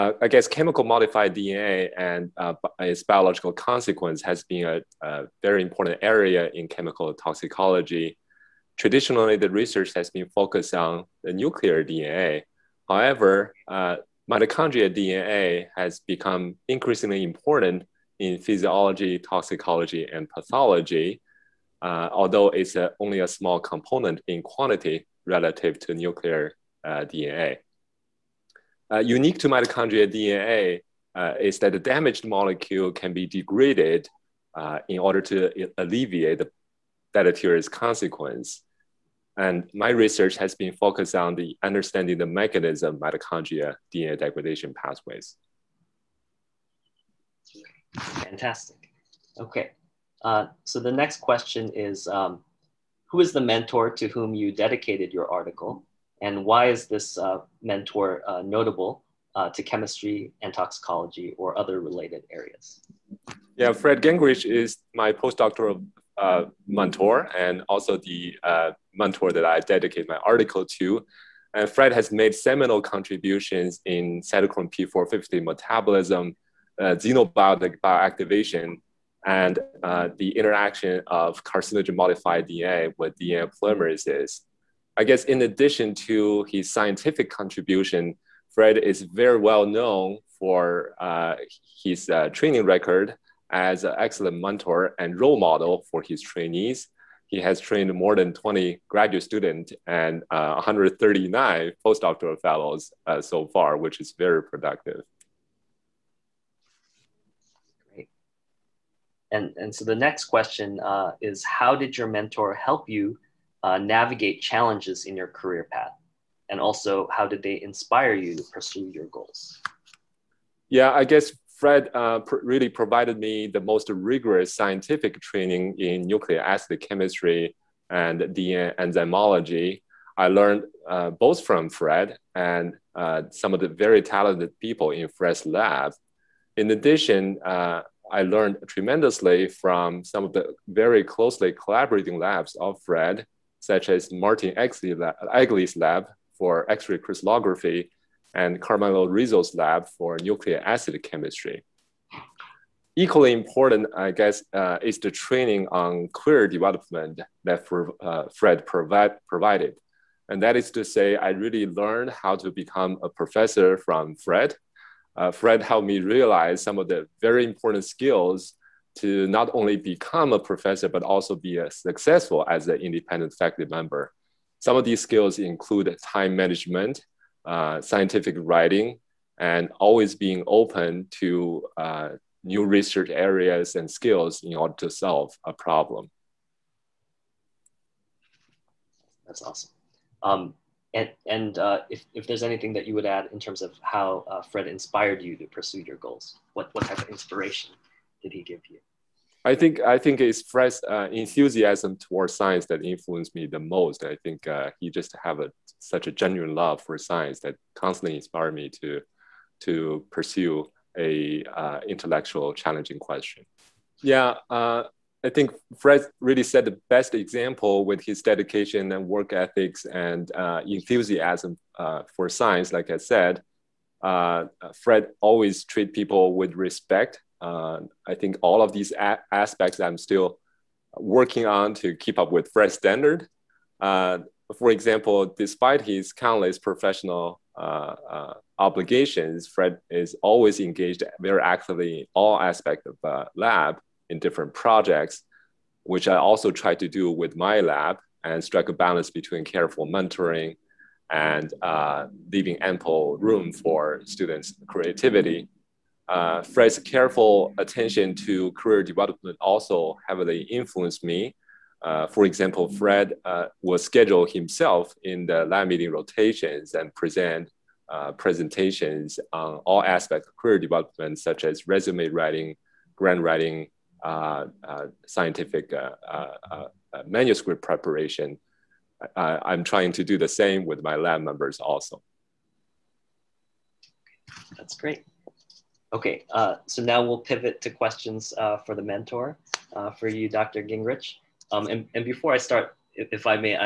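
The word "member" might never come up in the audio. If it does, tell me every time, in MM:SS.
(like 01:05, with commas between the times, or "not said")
02:53, 04:41.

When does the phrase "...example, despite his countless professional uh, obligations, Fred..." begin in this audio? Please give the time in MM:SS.
03:54.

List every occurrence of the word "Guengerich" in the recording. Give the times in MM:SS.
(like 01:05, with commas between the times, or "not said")
01:04, 04:50.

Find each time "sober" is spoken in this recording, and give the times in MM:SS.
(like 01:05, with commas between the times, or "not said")
not said.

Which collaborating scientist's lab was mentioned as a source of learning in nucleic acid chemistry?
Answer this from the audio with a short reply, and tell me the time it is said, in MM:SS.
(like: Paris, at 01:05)
Carmelo Rizzo, at 02:28.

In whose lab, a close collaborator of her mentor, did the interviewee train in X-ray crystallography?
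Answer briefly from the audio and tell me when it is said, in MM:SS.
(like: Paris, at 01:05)
Martin Egli, at 02:24.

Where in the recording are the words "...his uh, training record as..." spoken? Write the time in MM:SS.
01:31.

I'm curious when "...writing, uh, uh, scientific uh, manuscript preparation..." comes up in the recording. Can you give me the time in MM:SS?
04:33.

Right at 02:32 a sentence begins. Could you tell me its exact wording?
Equally important, I guess, uh, is the training on career development that for, uh, Fred provide, provided.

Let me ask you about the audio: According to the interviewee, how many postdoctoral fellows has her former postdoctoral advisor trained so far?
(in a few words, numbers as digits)
139.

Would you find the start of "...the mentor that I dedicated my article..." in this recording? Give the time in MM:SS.
01:07.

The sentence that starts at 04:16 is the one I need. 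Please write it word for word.
Uh, Fred's careful attention to career development also heavily influenced me.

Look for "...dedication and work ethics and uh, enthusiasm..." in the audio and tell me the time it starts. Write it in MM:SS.
03:38.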